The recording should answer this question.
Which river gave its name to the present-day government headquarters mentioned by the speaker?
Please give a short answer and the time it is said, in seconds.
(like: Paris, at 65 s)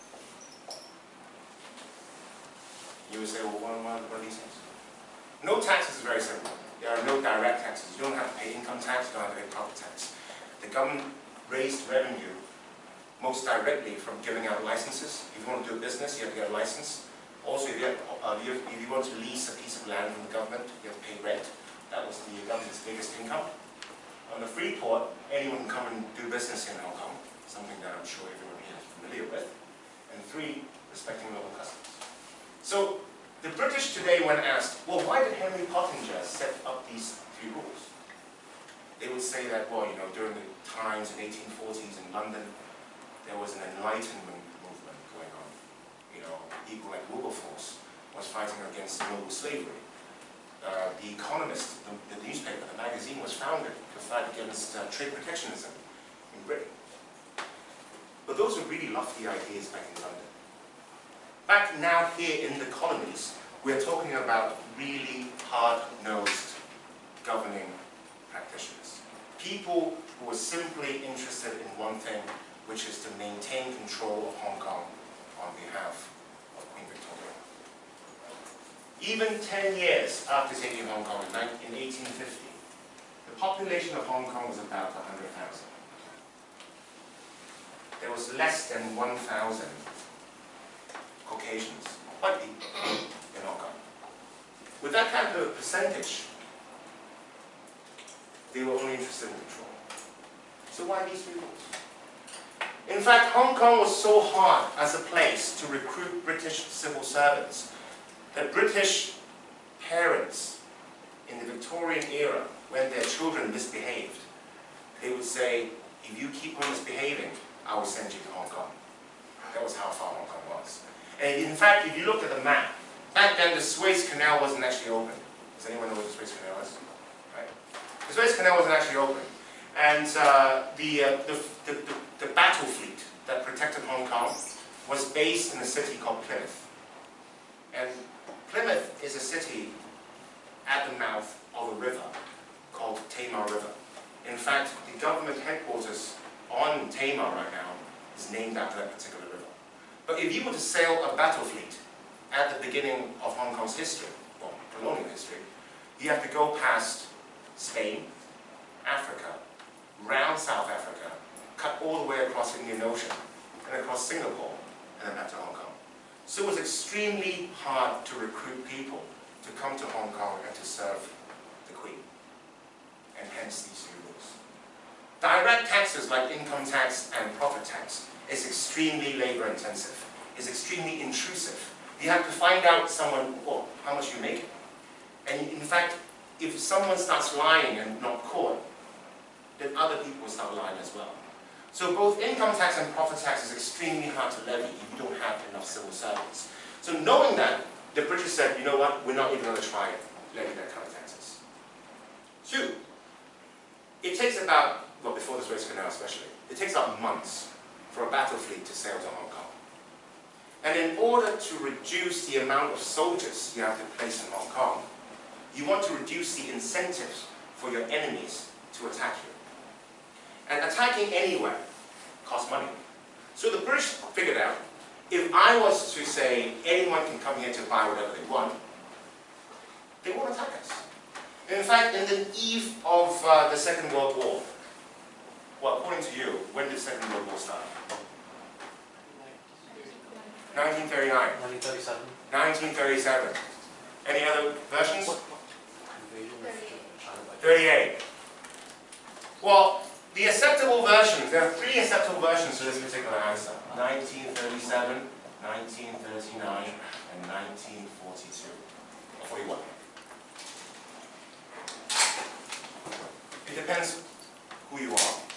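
Tamar River, at 143 s.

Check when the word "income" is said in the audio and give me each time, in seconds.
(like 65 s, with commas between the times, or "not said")
8 s, 23 s, 176 s, 192 s.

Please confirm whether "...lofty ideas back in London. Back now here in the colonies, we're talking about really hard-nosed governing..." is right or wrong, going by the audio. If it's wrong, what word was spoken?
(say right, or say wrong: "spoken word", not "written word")
right.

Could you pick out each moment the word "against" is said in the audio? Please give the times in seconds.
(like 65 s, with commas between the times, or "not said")
48 s, 54 s.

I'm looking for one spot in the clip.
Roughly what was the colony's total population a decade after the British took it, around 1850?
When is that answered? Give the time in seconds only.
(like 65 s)
84 s.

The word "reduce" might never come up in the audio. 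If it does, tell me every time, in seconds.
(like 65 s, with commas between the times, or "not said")
211 s, 215 s.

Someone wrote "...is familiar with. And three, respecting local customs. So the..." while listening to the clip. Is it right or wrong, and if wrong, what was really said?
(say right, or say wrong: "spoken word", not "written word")
right.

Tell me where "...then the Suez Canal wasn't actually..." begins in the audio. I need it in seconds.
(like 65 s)
123 s.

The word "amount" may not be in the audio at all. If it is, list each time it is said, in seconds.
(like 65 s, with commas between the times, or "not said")
212 s.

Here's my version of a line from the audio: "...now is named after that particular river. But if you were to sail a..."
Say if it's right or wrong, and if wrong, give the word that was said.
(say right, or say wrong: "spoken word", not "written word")
right.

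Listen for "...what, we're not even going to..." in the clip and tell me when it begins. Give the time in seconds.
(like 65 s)
198 s.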